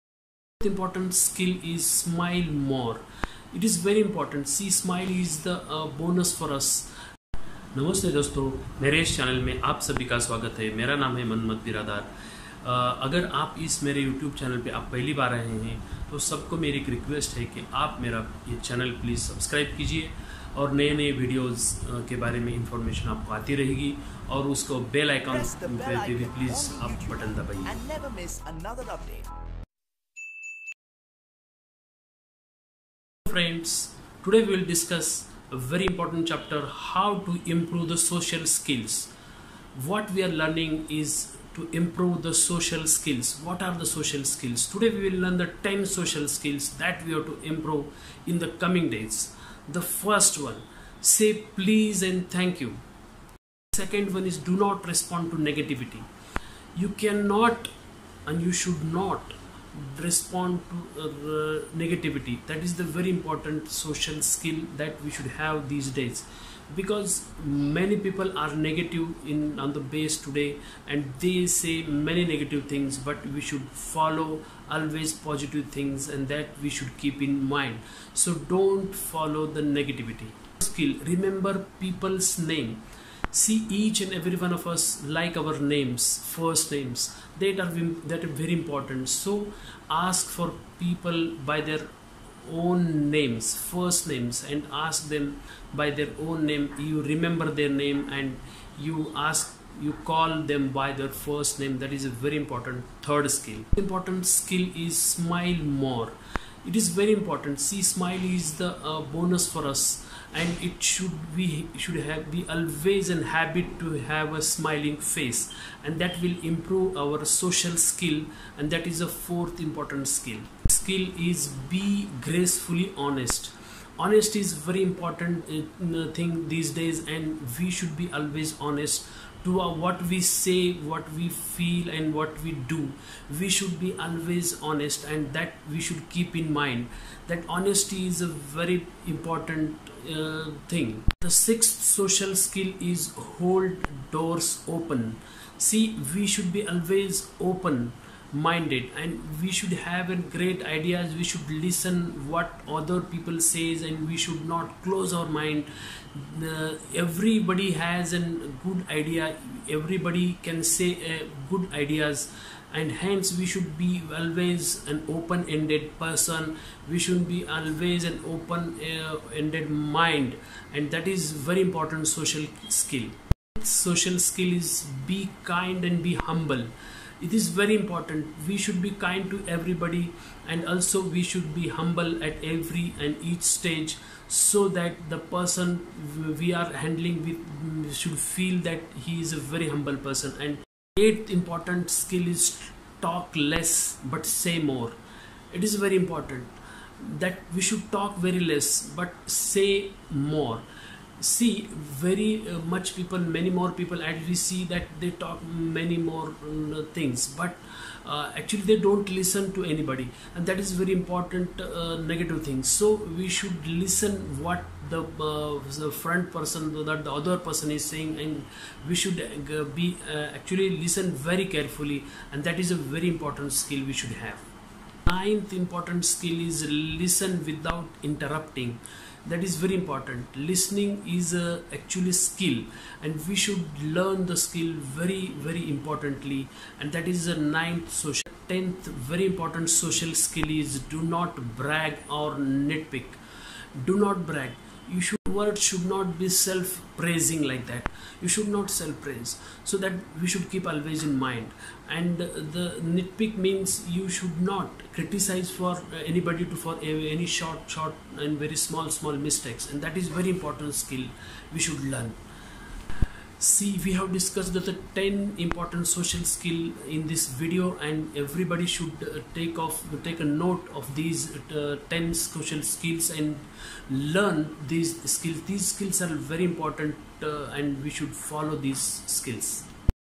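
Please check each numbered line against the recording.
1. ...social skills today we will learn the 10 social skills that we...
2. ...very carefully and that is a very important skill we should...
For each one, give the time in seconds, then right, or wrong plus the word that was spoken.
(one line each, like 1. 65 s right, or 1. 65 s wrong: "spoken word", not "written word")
1. 43 s right
2. 221 s right.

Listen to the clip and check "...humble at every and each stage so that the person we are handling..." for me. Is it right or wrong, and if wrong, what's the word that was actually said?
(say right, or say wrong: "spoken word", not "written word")
right.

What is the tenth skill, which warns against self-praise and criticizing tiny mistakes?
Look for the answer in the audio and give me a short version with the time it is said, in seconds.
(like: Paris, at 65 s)
Do not brag or nitpick, at 240 s.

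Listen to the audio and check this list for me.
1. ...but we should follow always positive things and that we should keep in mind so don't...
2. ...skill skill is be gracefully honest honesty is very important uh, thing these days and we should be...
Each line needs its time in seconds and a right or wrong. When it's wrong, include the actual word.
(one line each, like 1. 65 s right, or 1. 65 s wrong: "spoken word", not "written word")
1. 72 s right
2. 120 s right.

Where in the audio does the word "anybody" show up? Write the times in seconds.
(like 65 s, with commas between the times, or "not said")
209 s, 256 s.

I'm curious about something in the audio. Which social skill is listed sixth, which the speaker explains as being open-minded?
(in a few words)
Hold doors open.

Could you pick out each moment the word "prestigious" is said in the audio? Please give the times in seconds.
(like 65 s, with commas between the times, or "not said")
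not said.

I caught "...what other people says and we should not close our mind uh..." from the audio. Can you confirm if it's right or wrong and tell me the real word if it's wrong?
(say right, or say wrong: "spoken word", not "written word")
right.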